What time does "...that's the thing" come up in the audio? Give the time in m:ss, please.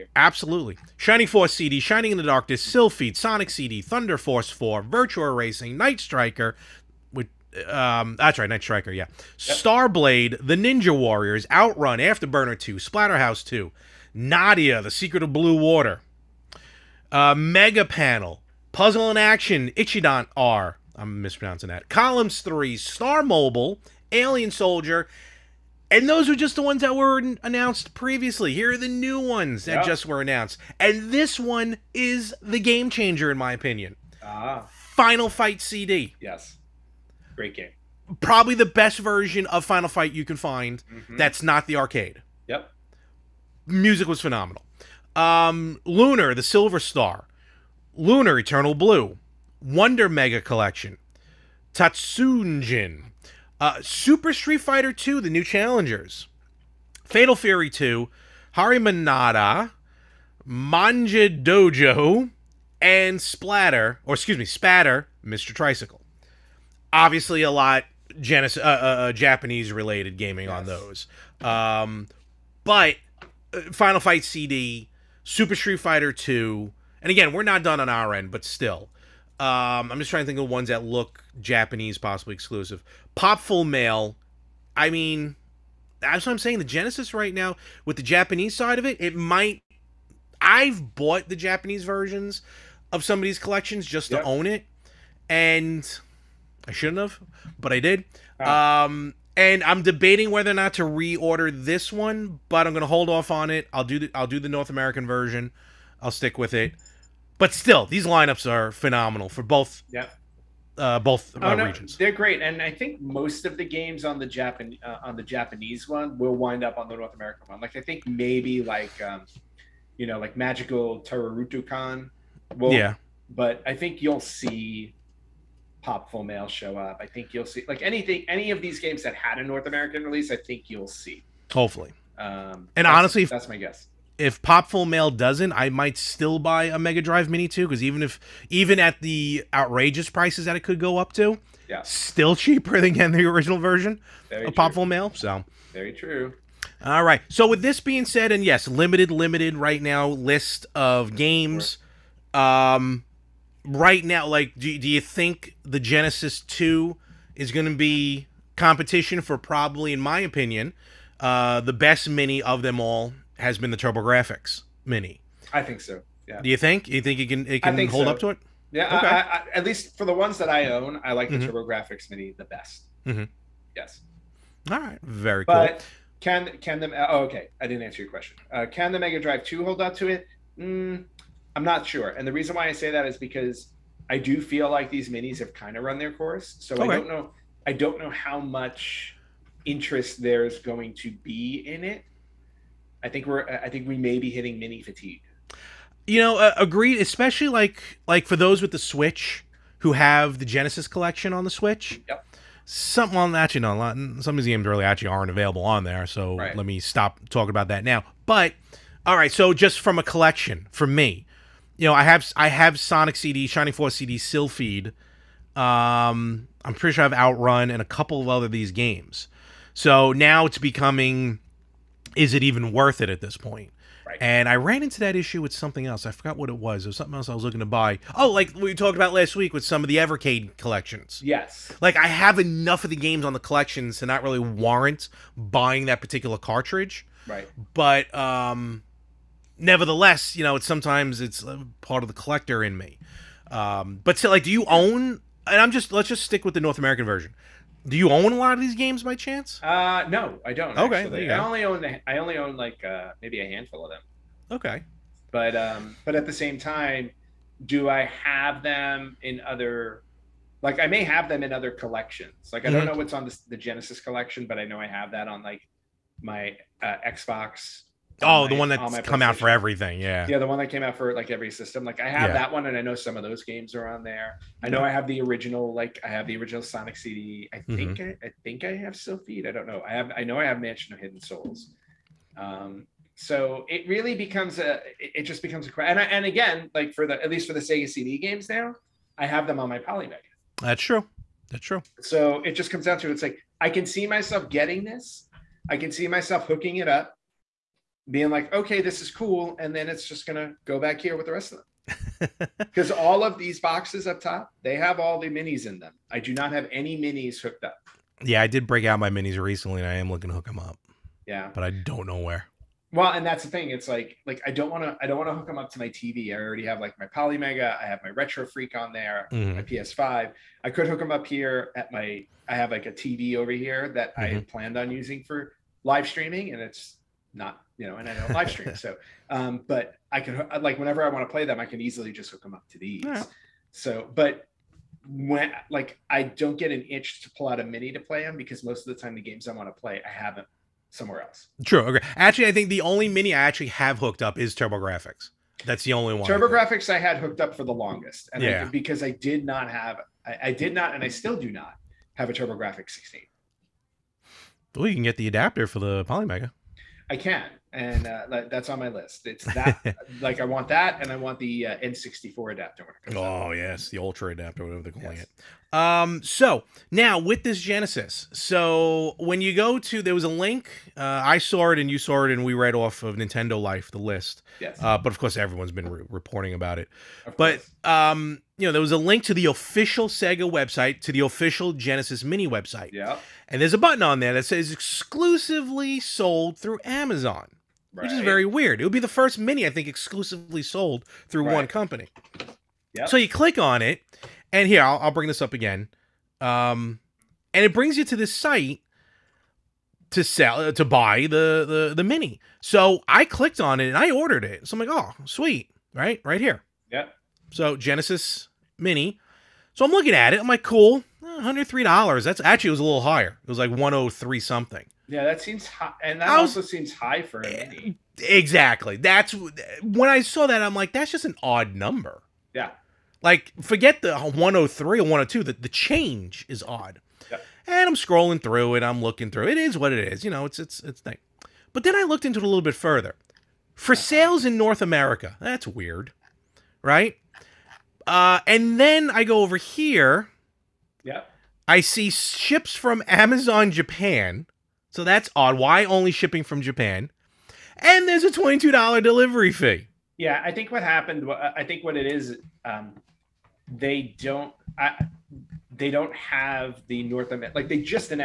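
5:13.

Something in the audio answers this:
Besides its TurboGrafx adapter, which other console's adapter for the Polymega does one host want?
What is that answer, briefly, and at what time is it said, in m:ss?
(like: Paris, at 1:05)
N64, at 6:01.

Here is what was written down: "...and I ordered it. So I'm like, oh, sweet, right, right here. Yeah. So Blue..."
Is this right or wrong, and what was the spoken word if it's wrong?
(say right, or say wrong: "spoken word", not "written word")
wrong: "Genesis", not "Blue".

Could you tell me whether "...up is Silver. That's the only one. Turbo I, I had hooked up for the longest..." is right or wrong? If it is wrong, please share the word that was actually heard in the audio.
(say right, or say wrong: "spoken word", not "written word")
wrong: "Grafx", not "Silver".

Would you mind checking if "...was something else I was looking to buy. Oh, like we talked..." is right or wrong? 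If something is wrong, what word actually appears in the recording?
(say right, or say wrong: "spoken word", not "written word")
right.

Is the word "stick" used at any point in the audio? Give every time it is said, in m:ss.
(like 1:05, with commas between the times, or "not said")
1:46, 4:06.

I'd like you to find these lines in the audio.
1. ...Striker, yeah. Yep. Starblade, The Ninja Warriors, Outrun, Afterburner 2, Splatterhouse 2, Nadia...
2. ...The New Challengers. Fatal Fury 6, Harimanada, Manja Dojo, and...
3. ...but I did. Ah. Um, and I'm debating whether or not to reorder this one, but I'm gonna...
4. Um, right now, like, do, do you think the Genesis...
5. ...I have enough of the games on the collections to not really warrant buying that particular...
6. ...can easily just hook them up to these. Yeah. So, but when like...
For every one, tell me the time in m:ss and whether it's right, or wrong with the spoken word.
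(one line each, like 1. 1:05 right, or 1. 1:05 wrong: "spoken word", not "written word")
1. 0:08 right
2. 0:55 wrong: "2", not "6"
3. 1:37 right
4. 2:32 right
5. 3:51 right
6. 5:31 right.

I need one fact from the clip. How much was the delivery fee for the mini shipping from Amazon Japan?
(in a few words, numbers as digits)
$22.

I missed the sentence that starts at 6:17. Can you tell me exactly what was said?
But um, you know, there was a link to the official Sega website, to the official Genesis Mini website.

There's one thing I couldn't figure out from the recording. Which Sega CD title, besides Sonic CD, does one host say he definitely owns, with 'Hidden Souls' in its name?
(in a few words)
Mansion of Hidden Souls.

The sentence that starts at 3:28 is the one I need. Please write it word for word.
But all right, so just from a collection for me, you know, I have I have Sonic CD, Shining Force CD, Silpheed.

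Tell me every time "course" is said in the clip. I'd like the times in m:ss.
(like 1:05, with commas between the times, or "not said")
3:06, 6:15.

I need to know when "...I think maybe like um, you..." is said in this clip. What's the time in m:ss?
1:57.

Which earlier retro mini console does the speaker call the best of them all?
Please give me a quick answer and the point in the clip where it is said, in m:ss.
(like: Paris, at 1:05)
TurboGrafx Mini, at 2:43.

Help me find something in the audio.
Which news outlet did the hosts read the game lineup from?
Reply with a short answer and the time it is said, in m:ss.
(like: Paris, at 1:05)
Nintendo Life, at 6:13.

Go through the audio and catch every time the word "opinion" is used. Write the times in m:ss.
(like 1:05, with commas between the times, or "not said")
0:33, 2:40.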